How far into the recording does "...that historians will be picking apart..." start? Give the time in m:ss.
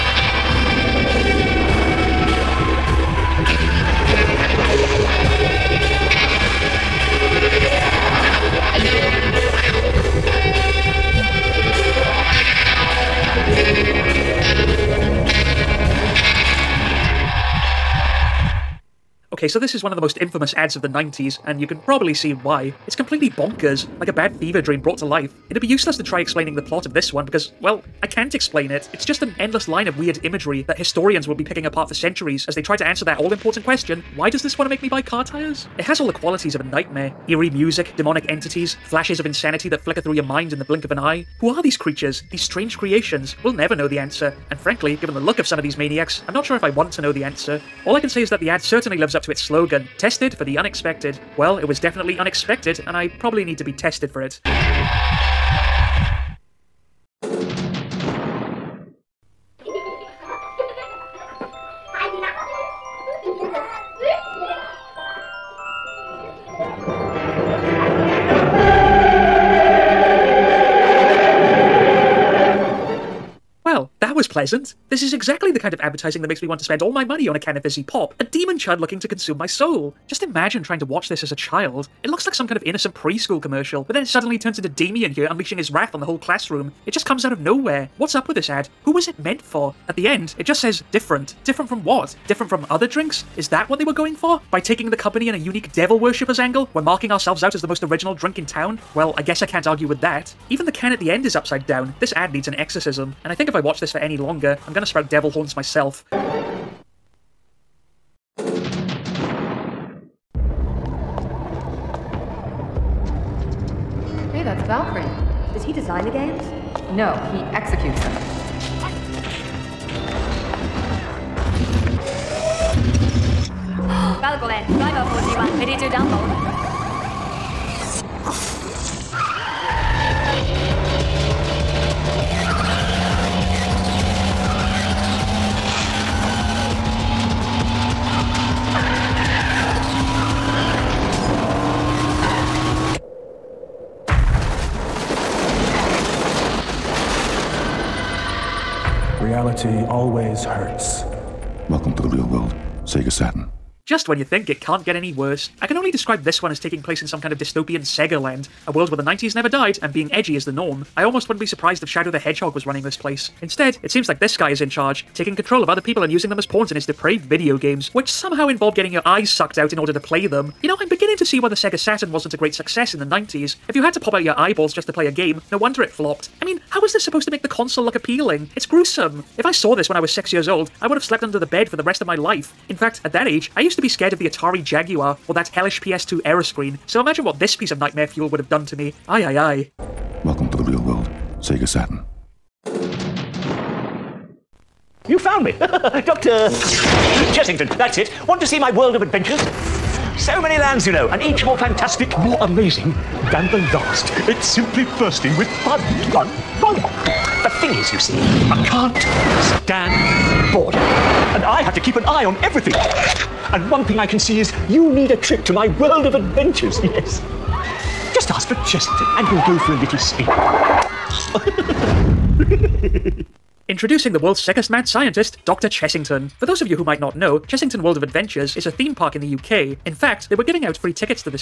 0:30.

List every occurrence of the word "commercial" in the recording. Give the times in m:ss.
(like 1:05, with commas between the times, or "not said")
1:23.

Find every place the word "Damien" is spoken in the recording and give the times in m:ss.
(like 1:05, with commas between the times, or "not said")
1:24.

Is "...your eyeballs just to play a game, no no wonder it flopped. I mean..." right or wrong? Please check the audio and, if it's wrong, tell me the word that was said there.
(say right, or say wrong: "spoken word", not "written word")
right.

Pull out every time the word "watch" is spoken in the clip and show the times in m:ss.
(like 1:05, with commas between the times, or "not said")
1:20, 1:43.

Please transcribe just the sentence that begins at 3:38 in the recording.
Just ask for Chester and we'll go for a little spin.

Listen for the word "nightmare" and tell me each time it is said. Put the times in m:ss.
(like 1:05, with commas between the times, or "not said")
0:36, 3:07.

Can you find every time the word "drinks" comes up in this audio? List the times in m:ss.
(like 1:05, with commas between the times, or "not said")
1:32, 1:38.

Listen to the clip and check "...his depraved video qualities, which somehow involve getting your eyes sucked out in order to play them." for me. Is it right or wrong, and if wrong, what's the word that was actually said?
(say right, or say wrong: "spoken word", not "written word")
wrong: "games", not "qualities".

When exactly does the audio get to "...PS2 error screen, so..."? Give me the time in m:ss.
3:05.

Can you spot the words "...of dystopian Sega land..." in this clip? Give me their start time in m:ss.
2:37.